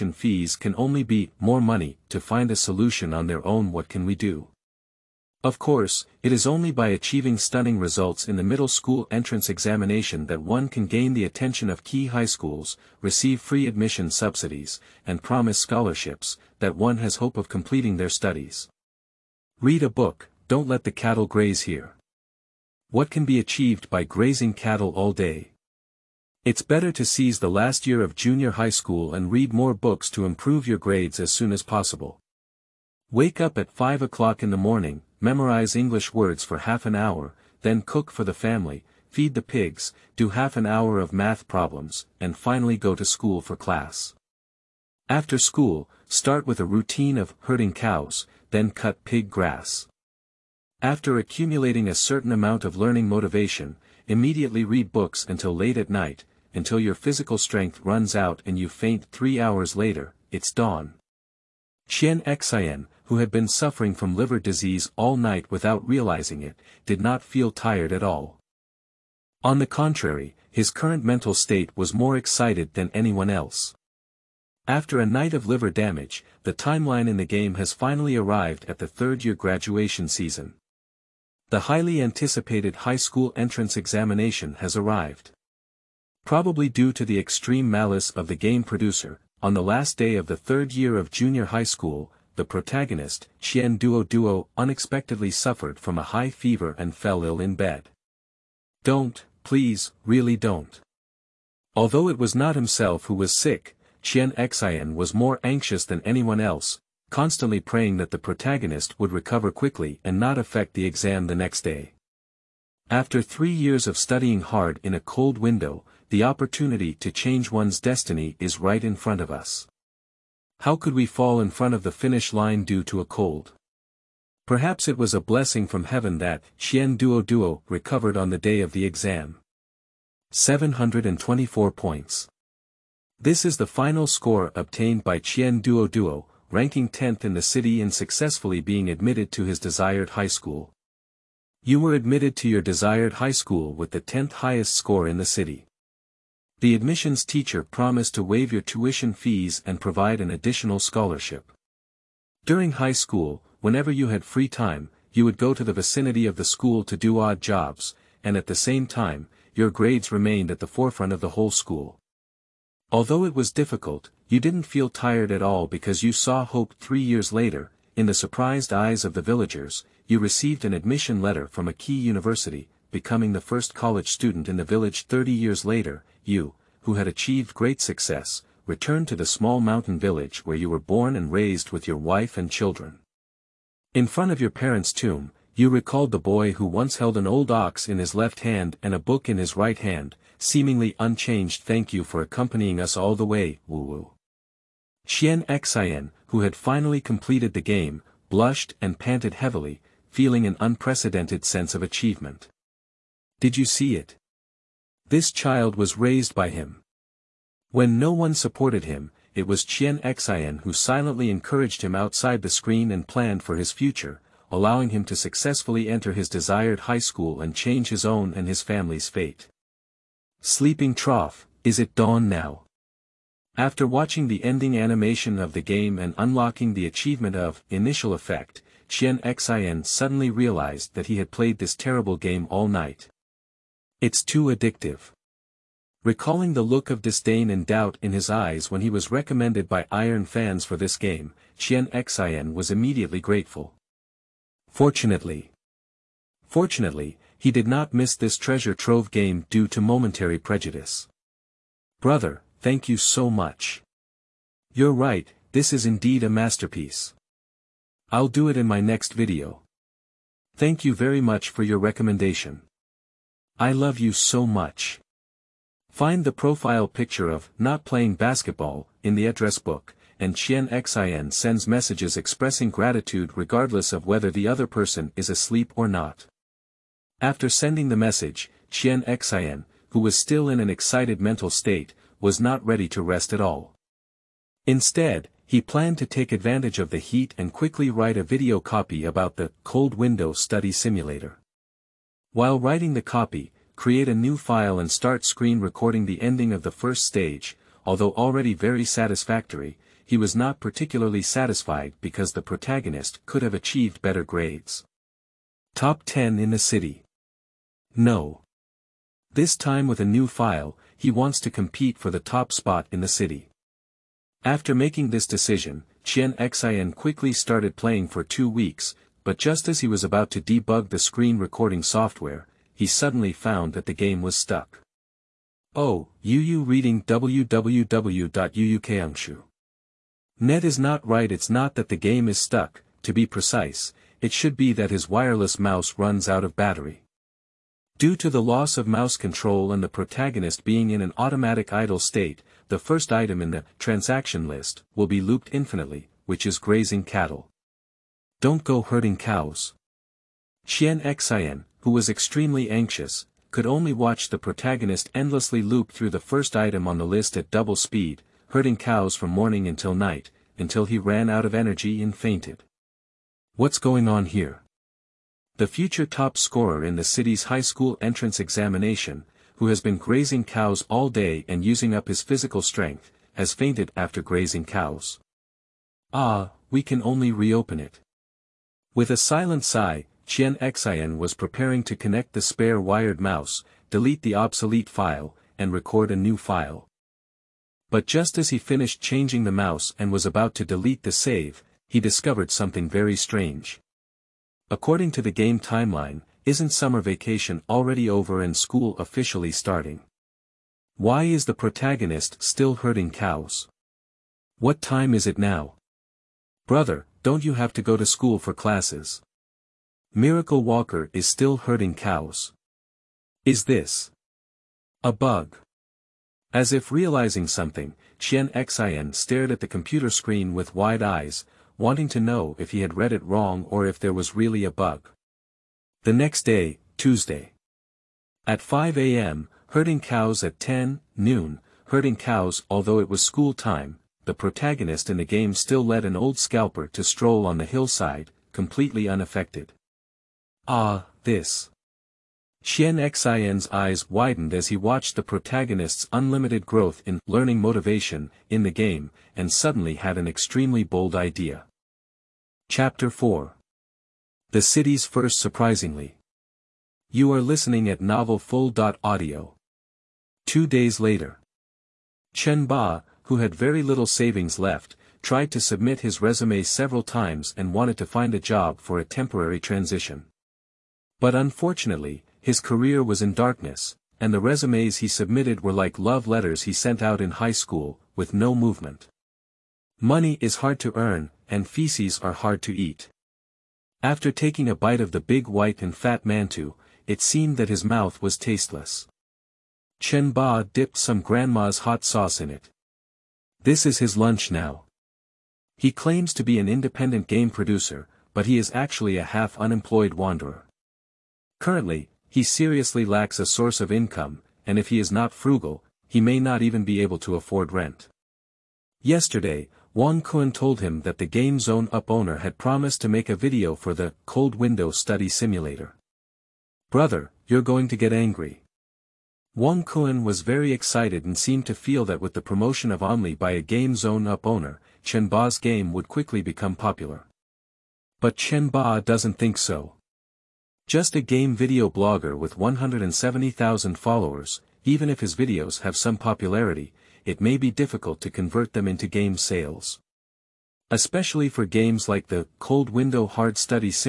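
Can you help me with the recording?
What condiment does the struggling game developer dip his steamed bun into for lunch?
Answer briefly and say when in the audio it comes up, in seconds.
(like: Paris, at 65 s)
grandma's hot sauce, at 491 s.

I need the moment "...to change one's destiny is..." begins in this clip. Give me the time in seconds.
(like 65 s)
116 s.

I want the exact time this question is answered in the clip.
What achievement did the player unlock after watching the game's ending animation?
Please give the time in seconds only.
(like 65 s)
227 s.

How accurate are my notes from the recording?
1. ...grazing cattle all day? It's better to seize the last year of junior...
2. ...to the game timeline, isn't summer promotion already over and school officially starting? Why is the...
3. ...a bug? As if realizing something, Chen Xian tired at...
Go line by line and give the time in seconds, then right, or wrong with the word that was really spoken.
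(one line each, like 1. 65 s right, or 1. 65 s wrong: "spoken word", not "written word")
1. 24 s right
2. 395 s wrong: "vacation", not "promotion"
3. 415 s wrong: "stared", not "tired".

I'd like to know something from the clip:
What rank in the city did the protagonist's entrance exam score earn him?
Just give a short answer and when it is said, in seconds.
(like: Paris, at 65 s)
10th, at 136 s.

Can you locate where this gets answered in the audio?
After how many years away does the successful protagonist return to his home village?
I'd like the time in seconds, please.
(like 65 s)
175 s.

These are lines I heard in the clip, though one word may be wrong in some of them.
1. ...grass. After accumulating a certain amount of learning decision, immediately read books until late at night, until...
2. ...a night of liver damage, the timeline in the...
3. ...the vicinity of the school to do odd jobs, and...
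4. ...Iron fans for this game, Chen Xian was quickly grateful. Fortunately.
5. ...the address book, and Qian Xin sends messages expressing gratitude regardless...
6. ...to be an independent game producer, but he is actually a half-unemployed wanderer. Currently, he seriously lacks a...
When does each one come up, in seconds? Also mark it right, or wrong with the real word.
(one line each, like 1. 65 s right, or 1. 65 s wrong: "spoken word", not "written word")
1. 49 s wrong: "motivation", not "decision"
2. 74 s right
3. 155 s right
4. 239 s wrong: "immediately", not "quickly"
5. 269 s right
6. 496 s right.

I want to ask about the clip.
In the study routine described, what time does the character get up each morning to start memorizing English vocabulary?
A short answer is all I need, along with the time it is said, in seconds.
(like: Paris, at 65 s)
5 o'clock, at 33 s.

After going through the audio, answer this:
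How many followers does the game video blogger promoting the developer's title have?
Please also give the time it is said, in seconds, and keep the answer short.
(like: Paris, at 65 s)
170,000, at 532 s.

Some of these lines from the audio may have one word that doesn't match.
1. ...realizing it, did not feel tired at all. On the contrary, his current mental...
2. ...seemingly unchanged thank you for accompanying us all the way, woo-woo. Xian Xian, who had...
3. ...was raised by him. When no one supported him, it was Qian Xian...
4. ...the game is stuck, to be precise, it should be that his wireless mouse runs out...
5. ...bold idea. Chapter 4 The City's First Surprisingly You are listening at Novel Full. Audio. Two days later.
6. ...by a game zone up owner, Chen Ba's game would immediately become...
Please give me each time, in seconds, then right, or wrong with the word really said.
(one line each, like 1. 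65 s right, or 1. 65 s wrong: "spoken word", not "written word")
1. 65 s right
2. 190 s right
3. 205 s right
4. 331 s right
5. 450 s right
6. 523 s wrong: "quickly", not "immediately".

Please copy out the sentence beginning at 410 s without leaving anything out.
Miracle Walker is still herding cows.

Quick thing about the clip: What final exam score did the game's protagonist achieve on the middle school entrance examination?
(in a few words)
724.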